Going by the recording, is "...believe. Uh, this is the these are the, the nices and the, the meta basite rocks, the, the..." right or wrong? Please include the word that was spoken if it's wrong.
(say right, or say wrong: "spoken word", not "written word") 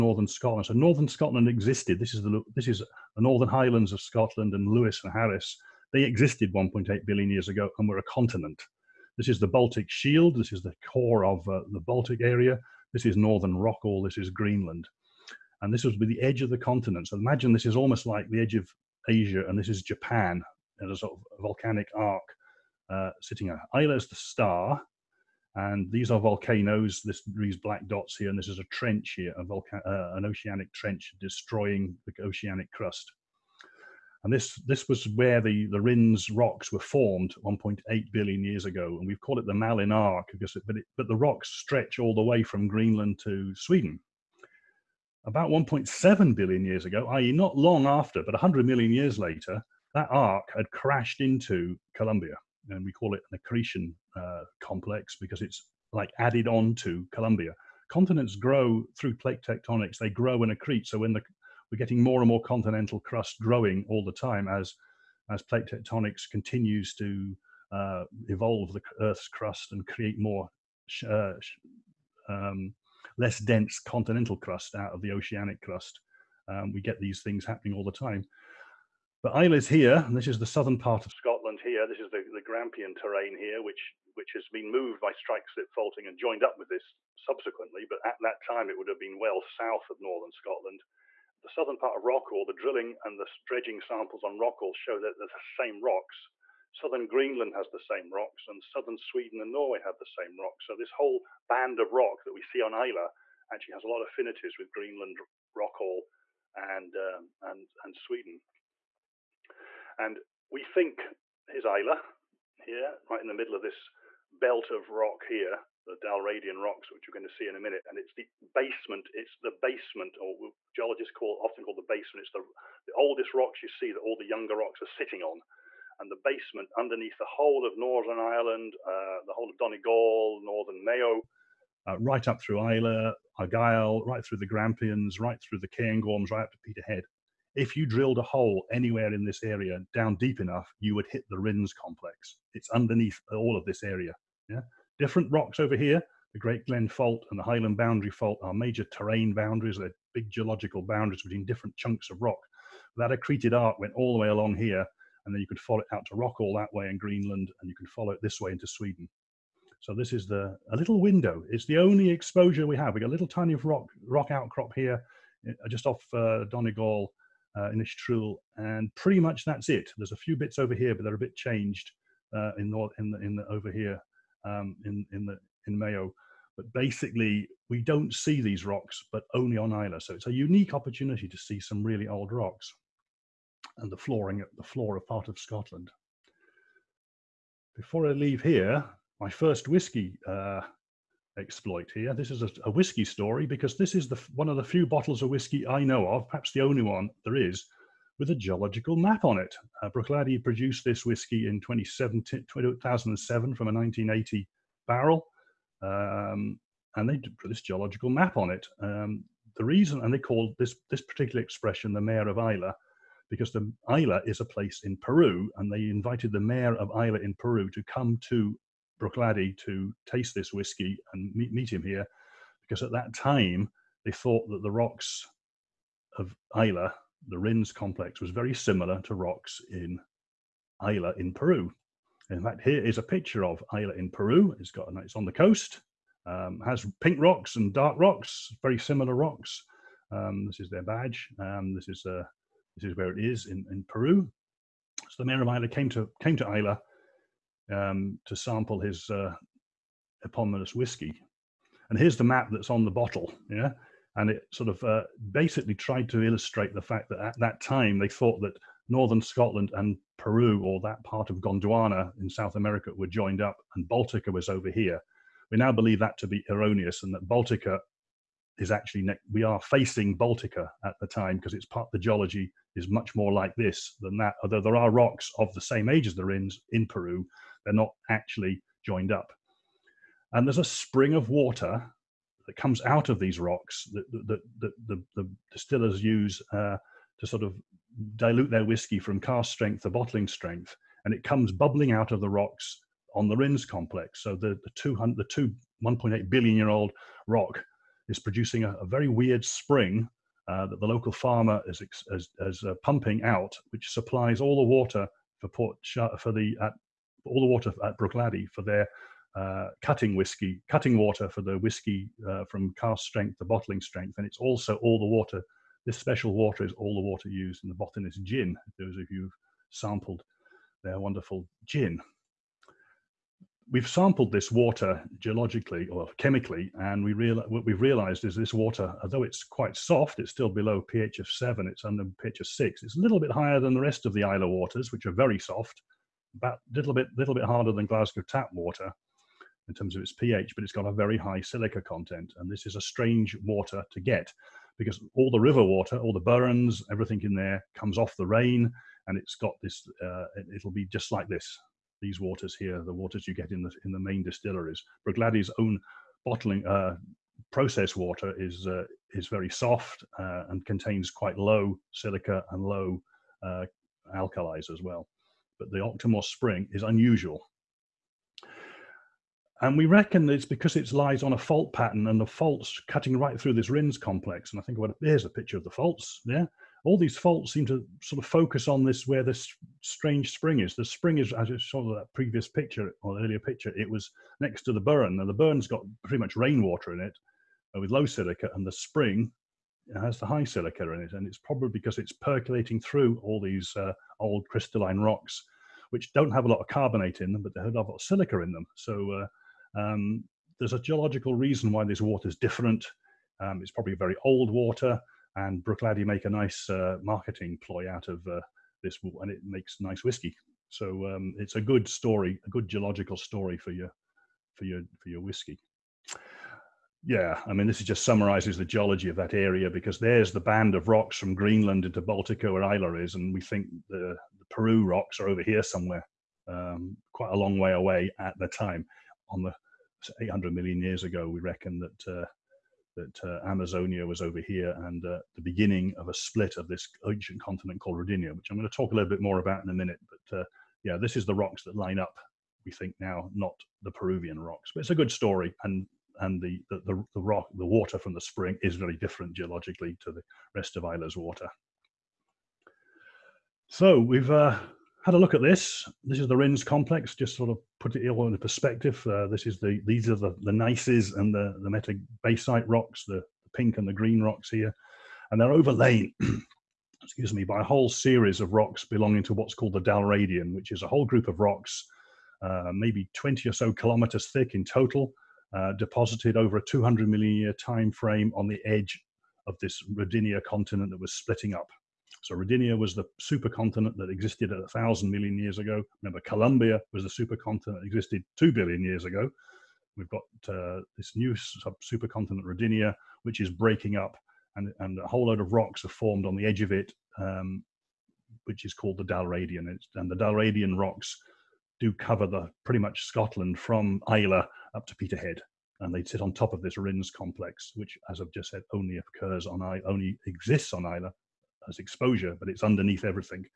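wrong: "perspective", not "believe".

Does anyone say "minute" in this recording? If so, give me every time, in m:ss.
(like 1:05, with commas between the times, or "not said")
1:57, 7:19.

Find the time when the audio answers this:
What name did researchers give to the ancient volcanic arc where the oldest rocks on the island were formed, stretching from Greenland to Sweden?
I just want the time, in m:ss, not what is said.
0:39.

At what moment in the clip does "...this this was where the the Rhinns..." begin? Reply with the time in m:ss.
0:34.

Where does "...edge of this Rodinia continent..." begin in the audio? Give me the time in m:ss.
7:58.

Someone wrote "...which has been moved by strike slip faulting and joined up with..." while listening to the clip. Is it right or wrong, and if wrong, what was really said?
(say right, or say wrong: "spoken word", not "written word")
right.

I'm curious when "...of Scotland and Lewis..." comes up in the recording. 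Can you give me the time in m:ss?
0:03.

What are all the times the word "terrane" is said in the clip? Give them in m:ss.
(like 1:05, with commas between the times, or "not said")
1:22, 2:28.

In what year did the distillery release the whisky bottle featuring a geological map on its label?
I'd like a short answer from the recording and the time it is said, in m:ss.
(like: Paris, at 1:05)
2007, at 3:21.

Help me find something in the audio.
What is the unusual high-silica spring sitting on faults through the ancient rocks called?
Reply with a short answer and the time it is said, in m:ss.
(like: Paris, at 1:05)
Octomore Spring, at 6:05.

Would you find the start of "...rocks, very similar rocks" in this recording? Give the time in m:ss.
3:57.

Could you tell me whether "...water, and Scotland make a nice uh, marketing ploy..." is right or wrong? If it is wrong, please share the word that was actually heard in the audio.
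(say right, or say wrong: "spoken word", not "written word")
wrong: "Bruichladdich", not "Scotland".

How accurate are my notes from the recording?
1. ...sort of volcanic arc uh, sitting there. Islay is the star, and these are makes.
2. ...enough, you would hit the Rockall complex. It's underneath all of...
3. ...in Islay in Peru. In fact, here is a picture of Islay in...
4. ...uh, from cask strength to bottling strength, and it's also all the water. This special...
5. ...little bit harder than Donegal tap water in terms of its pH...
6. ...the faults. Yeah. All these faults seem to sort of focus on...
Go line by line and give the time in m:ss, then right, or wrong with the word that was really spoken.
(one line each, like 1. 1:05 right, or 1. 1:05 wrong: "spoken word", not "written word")
1. 0:20 wrong: "volcanoes", not "makes"
2. 2:20 wrong: "Rhinns", not "Rockall"
3. 3:49 right
4. 5:12 right
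5. 5:37 wrong: "Glasgow", not "Donegal"
6. 6:15 right.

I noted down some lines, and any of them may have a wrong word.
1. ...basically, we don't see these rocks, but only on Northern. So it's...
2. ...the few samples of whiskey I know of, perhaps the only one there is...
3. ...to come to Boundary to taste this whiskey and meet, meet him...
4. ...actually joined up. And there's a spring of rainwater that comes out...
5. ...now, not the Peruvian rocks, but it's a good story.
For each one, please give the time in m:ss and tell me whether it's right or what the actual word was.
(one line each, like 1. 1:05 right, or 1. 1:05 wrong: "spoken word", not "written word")
1. 2:56 wrong: "Islay", not "Northern"
2. 3:14 wrong: "bottles", not "samples"
3. 3:37 wrong: "Bruichladdich", not "Boundary"
4. 4:38 wrong: "water", not "rainwater"
5. 7:22 right.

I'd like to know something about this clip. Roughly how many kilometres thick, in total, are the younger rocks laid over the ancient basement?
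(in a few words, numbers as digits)
20.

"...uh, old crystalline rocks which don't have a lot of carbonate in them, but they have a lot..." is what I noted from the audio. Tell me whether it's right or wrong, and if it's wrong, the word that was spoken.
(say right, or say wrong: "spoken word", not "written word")
right.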